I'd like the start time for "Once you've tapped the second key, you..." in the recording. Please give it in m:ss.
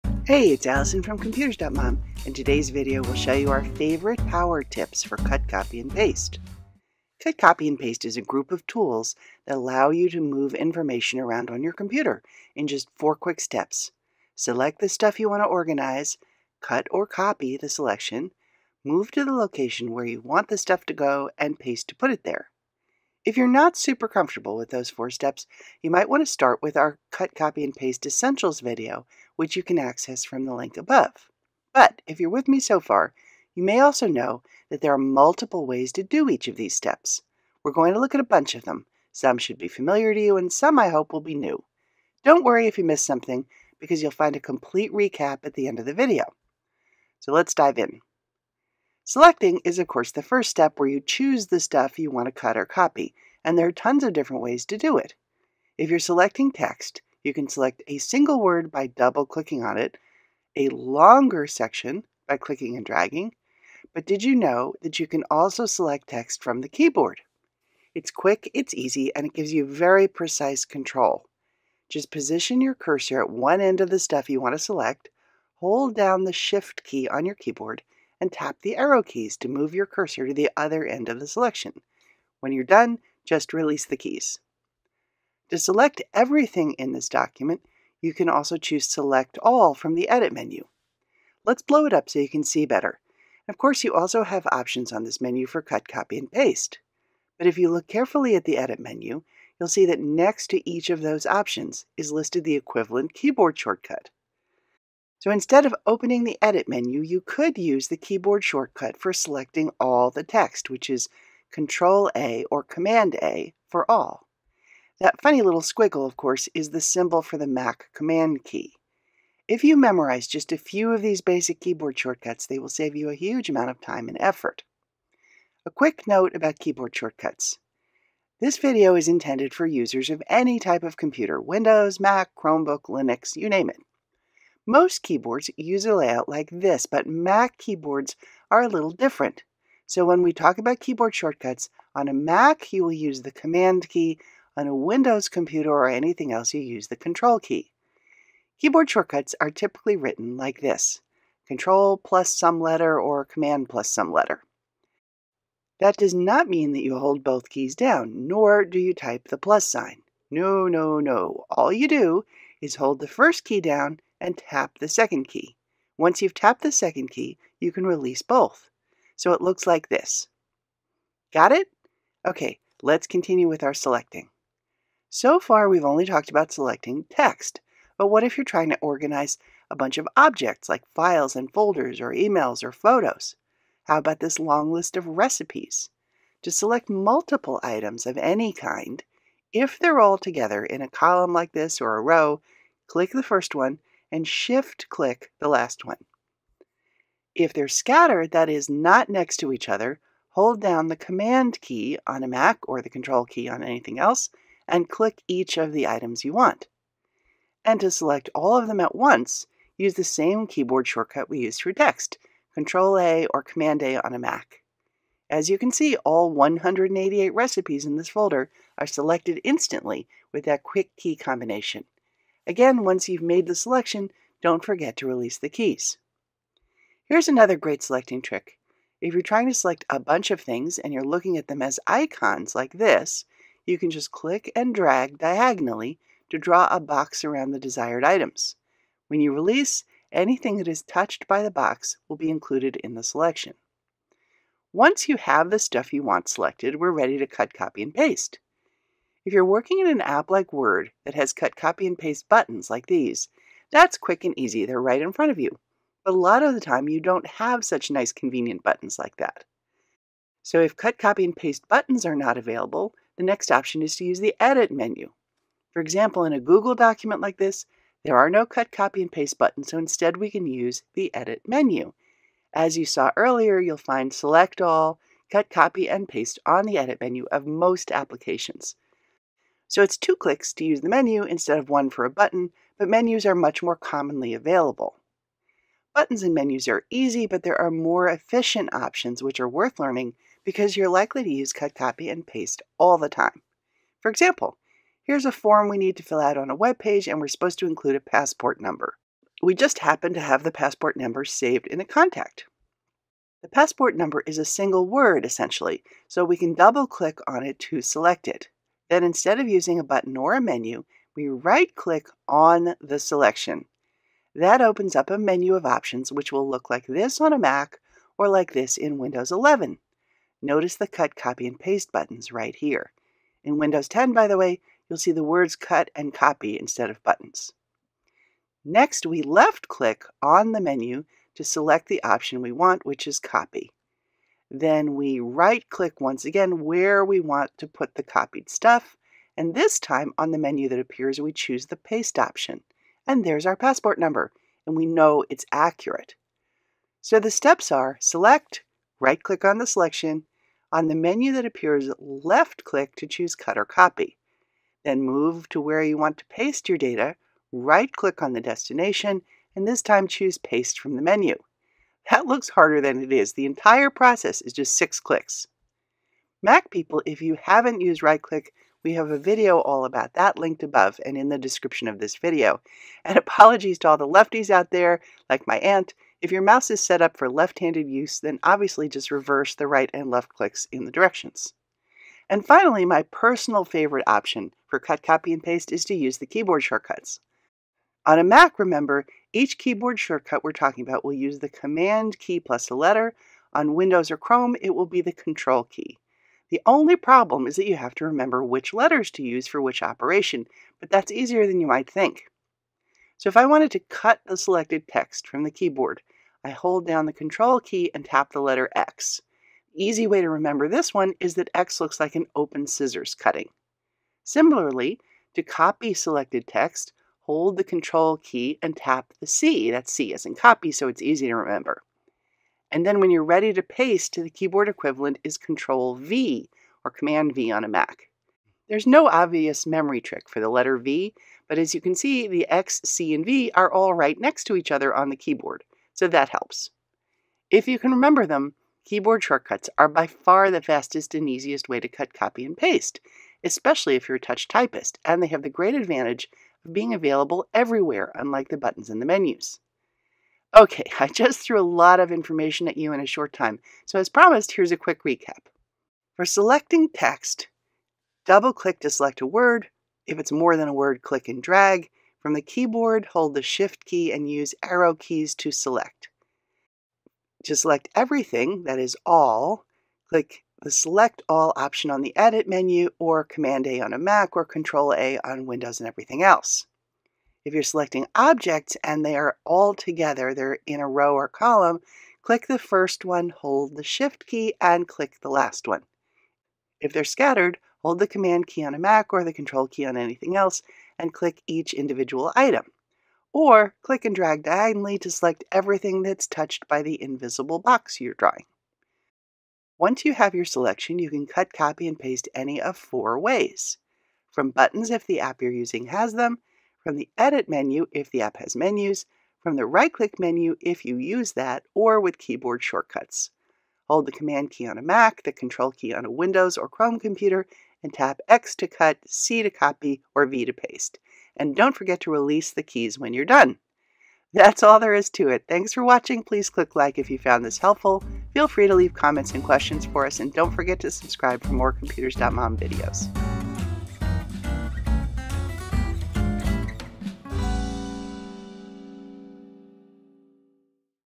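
2:45.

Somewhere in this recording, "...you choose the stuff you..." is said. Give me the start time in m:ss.
0:50.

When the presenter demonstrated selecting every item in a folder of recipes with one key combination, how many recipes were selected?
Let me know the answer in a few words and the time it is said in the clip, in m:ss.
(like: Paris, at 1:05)
188, at 3:36.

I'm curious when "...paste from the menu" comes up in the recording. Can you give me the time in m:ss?
6:00.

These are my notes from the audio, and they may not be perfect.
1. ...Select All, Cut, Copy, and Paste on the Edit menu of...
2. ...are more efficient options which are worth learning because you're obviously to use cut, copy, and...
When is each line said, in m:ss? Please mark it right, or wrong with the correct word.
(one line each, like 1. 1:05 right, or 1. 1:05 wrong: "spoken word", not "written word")
1. 4:34 right
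2. 4:47 wrong: "likely", not "obviously".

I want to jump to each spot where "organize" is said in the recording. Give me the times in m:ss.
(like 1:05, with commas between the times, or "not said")
0:15, 2:58.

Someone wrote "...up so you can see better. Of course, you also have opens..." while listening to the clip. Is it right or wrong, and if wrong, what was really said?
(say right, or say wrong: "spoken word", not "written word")
wrong: "options", not "opens".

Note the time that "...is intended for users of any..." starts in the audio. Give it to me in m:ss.
2:08.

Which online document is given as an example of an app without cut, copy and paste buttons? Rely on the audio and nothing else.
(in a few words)
Google document.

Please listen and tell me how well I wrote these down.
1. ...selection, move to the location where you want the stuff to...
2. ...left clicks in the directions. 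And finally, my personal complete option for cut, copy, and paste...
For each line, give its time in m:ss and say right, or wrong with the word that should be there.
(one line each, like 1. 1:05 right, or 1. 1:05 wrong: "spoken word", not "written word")
1. 0:17 right
2. 6:20 wrong: "favorite", not "complete".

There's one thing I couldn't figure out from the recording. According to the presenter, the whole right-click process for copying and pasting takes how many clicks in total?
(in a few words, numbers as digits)
6.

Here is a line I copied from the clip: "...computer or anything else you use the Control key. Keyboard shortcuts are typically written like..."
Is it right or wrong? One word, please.
right.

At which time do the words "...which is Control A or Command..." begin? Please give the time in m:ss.
1:50.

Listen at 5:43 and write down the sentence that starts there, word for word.
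And there's our passport number, and we know it's accurate.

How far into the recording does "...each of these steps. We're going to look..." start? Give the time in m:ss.
0:36.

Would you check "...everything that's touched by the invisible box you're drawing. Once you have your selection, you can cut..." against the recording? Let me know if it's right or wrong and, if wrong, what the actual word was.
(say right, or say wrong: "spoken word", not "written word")
right.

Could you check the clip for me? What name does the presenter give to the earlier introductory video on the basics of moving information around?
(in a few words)
Cut, Copy, and Paste Essentials.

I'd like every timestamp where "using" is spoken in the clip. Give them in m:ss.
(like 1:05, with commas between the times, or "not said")
5:09, 8:25.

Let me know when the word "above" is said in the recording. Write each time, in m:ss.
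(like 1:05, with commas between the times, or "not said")
0:30, 6:10.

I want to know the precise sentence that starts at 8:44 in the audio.
That's all there is to it.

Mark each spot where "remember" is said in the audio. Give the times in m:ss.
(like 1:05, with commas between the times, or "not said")
6:28, 6:38, 6:50, 7:01, 7:17.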